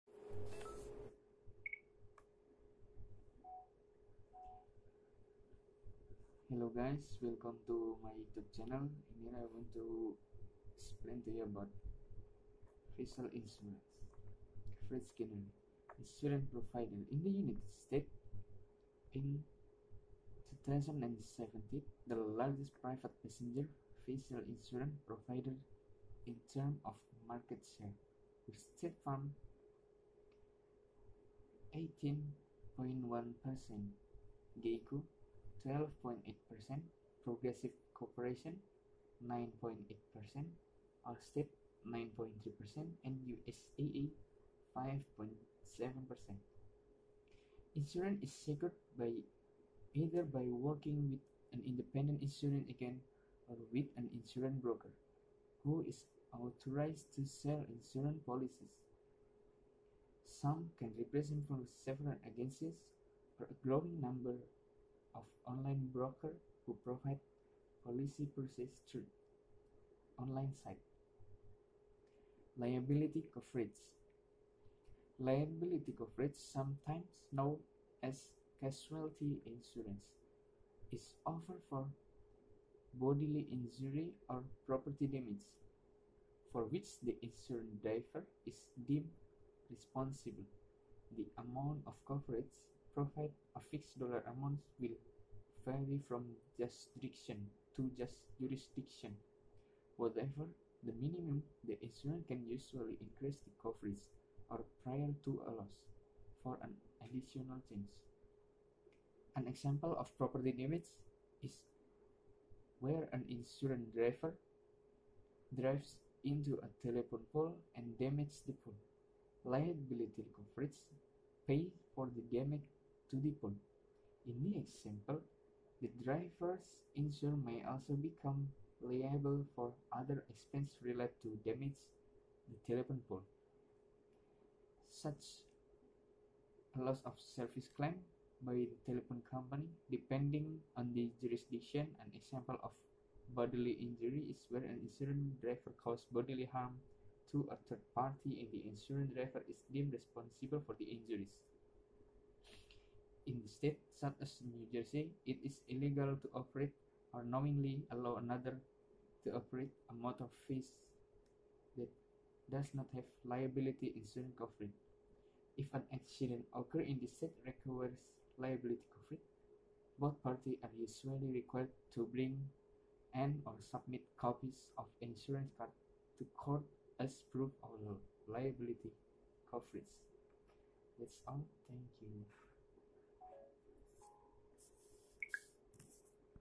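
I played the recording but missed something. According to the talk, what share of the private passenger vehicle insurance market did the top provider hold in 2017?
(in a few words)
18.1%.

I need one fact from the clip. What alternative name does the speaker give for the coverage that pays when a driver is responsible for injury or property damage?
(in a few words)
casualty insurance.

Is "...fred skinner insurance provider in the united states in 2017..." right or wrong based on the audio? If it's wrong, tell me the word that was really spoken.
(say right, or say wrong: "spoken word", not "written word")
right.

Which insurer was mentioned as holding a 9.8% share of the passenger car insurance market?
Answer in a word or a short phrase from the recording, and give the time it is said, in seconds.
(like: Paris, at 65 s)
Progressive Corporation, at 37 s.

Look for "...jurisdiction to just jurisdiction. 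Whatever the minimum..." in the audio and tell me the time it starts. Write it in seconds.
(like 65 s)
96 s.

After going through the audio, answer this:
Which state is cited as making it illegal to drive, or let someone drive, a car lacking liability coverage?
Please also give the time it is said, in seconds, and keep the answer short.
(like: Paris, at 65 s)
New Jersey, at 154 s.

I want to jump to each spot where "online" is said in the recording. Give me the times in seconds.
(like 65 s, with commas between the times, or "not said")
65 s, 70 s.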